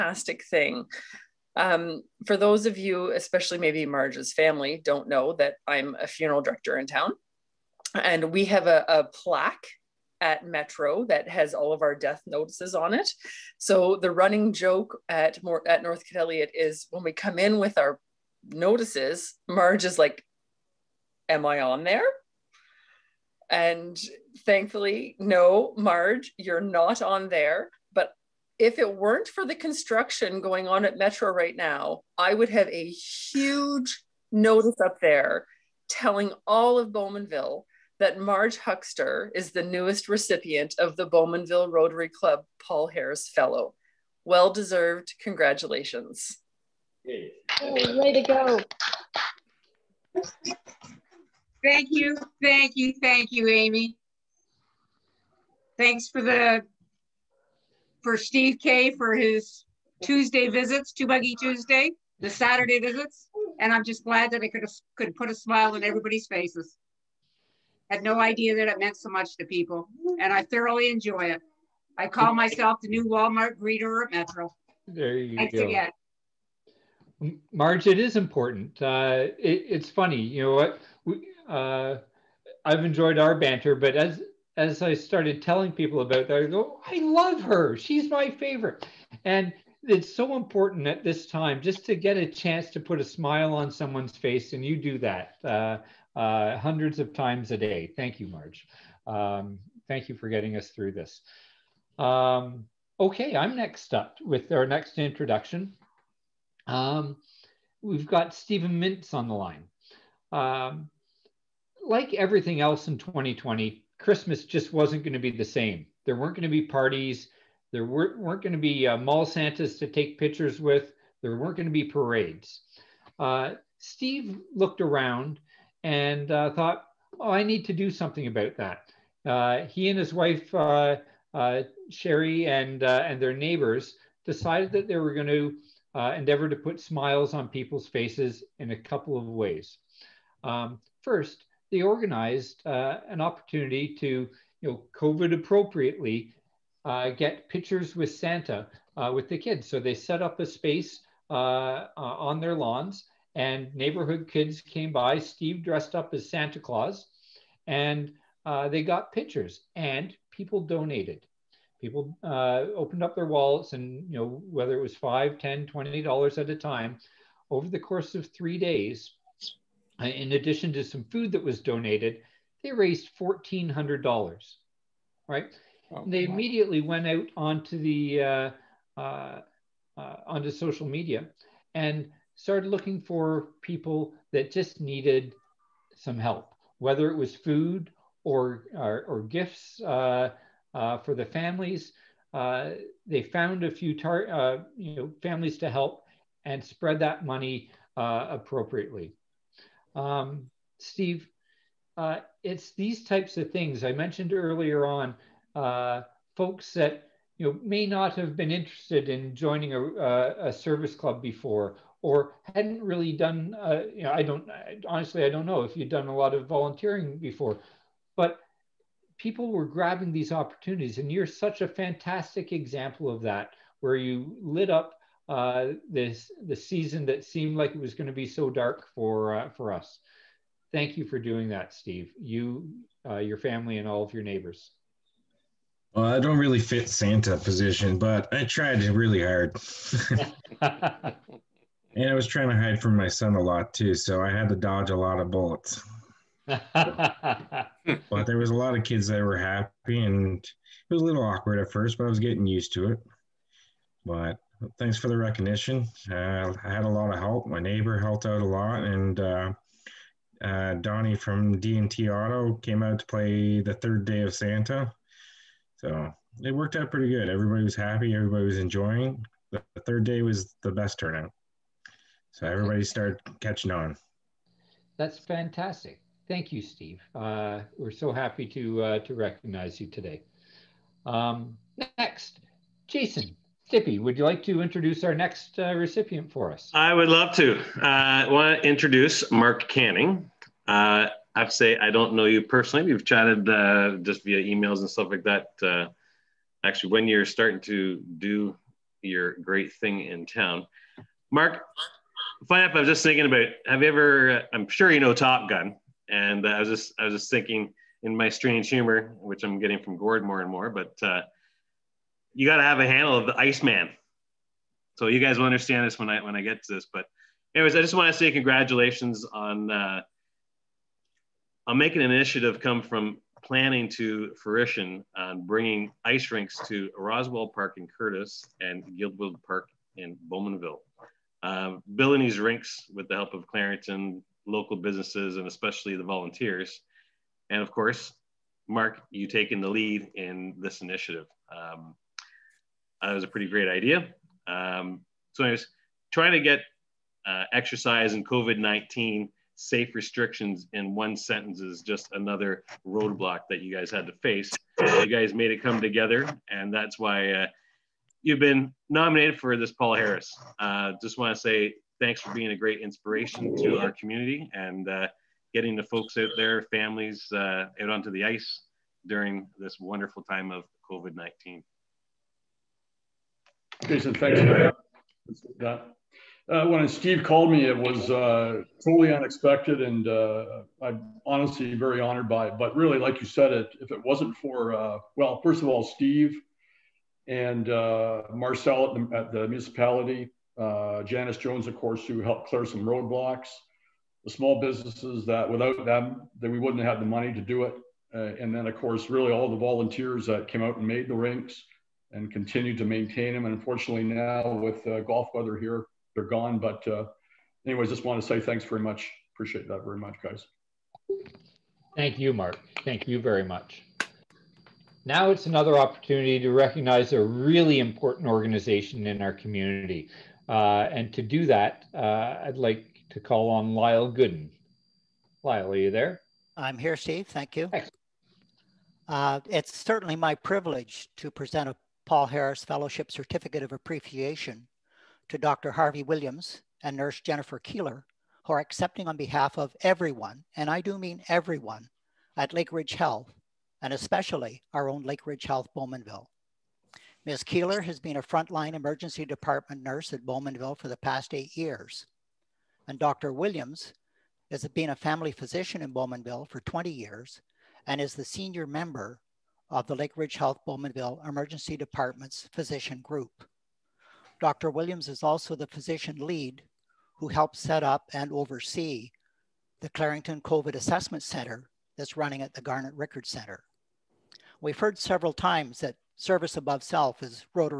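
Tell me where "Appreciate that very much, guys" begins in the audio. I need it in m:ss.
6:49.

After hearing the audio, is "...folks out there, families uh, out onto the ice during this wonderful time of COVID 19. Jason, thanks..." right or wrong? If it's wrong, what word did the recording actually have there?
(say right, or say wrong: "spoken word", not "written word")
right.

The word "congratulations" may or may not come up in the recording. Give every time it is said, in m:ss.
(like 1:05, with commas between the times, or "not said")
0:45, 5:18.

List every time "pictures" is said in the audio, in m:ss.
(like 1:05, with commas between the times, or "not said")
2:00, 2:27, 2:39.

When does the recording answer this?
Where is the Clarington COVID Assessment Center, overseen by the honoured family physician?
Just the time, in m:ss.
7:52.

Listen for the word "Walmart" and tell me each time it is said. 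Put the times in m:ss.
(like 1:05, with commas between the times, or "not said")
1:13.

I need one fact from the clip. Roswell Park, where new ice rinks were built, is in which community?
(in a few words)
Courtice.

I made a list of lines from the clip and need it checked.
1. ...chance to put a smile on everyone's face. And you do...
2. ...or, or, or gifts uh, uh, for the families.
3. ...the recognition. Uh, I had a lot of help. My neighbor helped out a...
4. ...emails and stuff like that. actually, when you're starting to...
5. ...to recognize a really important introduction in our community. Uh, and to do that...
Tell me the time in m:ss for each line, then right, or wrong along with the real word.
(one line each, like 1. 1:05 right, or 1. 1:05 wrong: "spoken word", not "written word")
1. 1:32 wrong: "someone", not "everyone"
2. 3:08 right
3. 4:15 right
4. 4:54 right
5. 6:56 wrong: "organization", not "introduction".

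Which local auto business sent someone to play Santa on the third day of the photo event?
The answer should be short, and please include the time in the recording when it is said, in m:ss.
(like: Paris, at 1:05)
D&T Auto, at 4:21.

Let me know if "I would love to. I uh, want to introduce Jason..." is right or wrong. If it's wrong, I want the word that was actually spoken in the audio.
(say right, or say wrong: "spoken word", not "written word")
wrong: "Mark", not "Jason".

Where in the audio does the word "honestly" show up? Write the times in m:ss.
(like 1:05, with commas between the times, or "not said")
3:34, 6:21.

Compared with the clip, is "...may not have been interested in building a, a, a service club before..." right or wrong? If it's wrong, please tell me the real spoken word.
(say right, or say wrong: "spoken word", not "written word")
wrong: "joining", not "building".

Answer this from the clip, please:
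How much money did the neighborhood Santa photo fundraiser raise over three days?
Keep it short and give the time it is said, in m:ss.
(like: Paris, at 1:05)
$1,400, at 2:53.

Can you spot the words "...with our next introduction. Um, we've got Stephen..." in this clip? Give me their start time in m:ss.
1:44.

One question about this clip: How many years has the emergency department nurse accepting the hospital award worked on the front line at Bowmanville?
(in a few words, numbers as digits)
8.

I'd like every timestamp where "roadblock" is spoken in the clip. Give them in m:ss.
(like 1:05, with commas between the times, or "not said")
5:52, 6:32.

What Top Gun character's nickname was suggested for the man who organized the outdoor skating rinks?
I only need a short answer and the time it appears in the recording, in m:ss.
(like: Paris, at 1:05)
Iceman, at 5:13.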